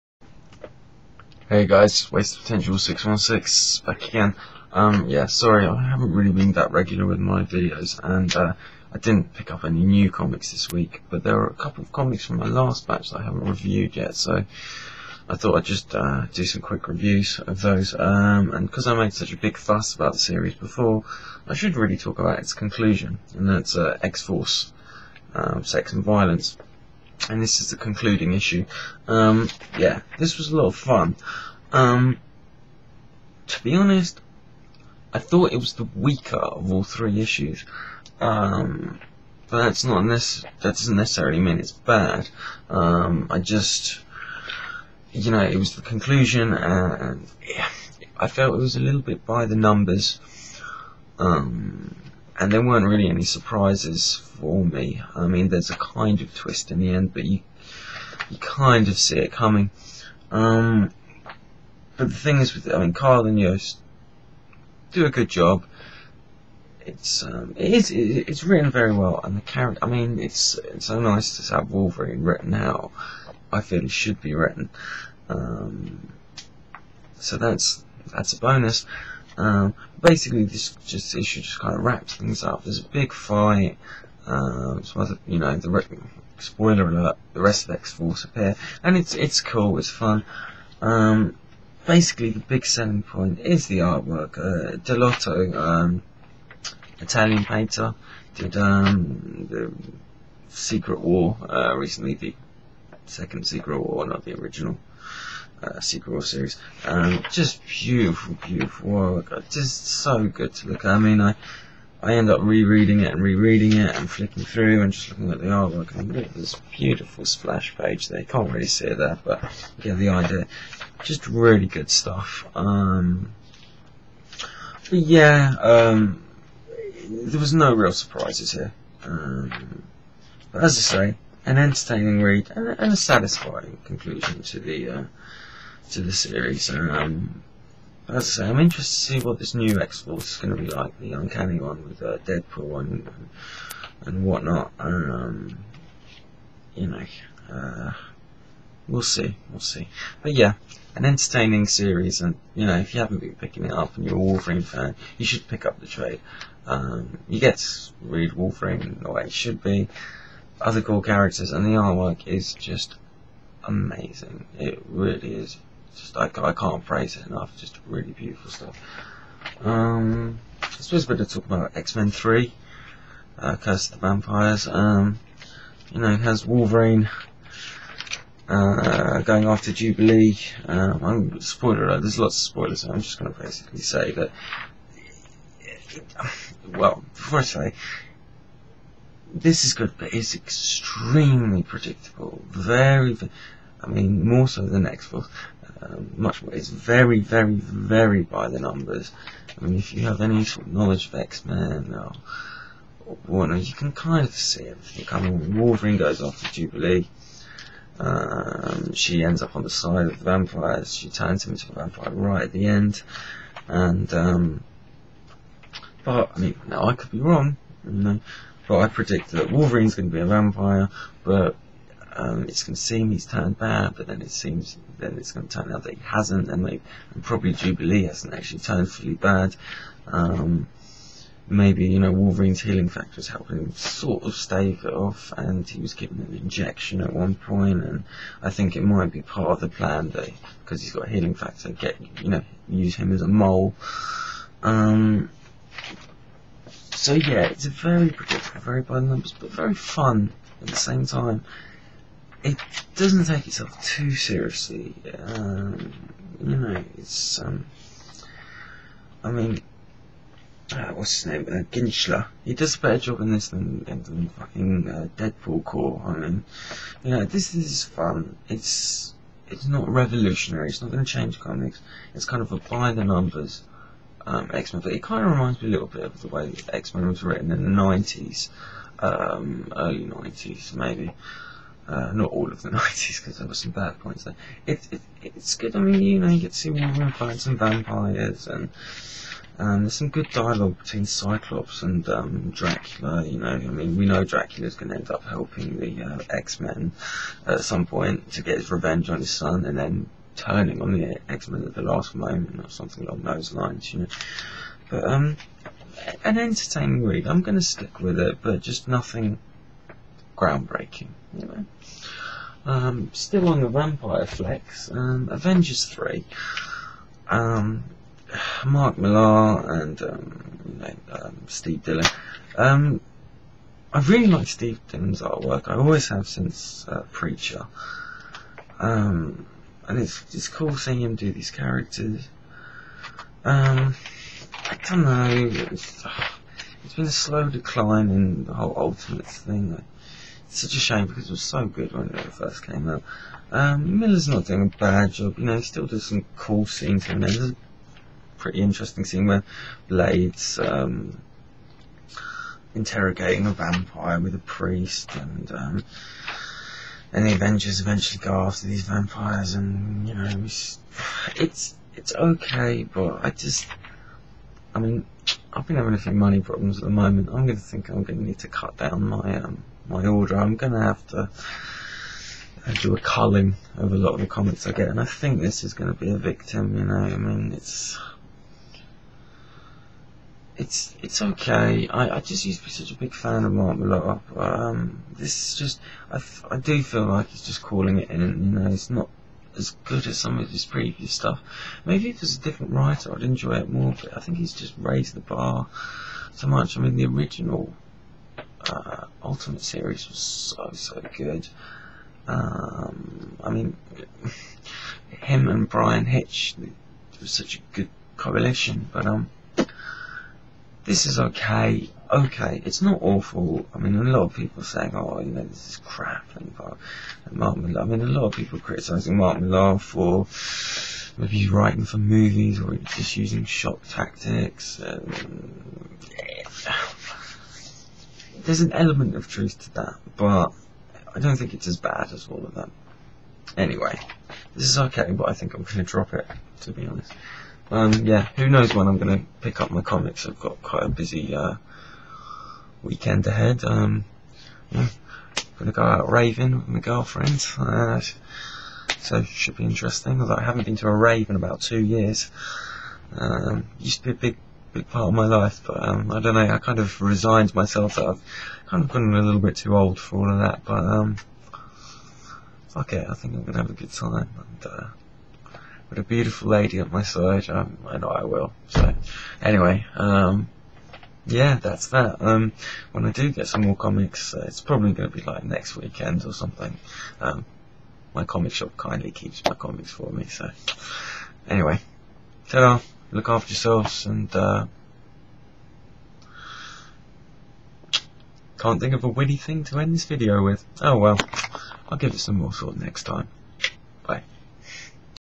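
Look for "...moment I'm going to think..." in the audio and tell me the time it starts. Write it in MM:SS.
06:06.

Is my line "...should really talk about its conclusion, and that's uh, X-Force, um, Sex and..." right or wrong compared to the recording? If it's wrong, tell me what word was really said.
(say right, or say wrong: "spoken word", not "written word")
right.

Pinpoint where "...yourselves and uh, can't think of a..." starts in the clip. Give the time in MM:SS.
08:03.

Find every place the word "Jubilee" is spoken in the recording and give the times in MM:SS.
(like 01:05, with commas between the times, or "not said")
02:59, 03:26, 03:47.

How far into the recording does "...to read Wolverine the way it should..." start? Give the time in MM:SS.
02:37.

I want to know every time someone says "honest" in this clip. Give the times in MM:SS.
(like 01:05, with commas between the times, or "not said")
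00:33, 07:16.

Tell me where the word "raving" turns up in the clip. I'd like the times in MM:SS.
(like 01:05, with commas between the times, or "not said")
07:26.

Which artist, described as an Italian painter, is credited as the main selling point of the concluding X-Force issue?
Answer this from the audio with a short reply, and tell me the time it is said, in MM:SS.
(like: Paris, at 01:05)
Dell'Otto, at 01:34.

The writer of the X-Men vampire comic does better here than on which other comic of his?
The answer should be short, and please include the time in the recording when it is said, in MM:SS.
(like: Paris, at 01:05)
Deadpool Corps, at 04:25.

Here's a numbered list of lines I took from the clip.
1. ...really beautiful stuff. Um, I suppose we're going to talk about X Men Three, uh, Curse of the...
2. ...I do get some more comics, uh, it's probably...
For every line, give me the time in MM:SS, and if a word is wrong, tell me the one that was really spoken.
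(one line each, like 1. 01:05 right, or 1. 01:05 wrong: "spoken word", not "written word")
1. 02:47 right
2. 07:53 right.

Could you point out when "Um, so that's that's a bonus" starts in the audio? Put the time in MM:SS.
01:15.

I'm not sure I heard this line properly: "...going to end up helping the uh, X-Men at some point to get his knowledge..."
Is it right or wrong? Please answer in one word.
wrong.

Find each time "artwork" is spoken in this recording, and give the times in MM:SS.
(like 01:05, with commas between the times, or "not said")
01:33, 01:55, 02:41, 05:25.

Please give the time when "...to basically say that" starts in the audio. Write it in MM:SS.
03:03.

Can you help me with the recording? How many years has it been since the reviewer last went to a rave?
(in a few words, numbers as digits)
2.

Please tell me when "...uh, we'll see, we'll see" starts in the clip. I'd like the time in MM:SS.
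02:27.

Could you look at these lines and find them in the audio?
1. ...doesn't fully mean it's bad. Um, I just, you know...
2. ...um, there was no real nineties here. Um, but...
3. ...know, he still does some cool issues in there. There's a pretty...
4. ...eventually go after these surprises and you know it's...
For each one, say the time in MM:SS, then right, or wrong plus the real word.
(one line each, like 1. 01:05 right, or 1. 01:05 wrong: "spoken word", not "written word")
1. 00:40 wrong: "necessarily", not "fully"
2. 02:05 wrong: "surprises", not "nineties"
3. 05:45 wrong: "scenes", not "issues"
4. 05:57 wrong: "vampires", not "surprises".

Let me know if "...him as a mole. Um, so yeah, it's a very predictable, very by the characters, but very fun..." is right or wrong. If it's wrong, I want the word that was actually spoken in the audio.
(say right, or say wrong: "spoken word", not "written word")
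wrong: "numbers", not "characters".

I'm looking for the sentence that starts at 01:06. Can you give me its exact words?
It's um, it is it's written very well, and the character.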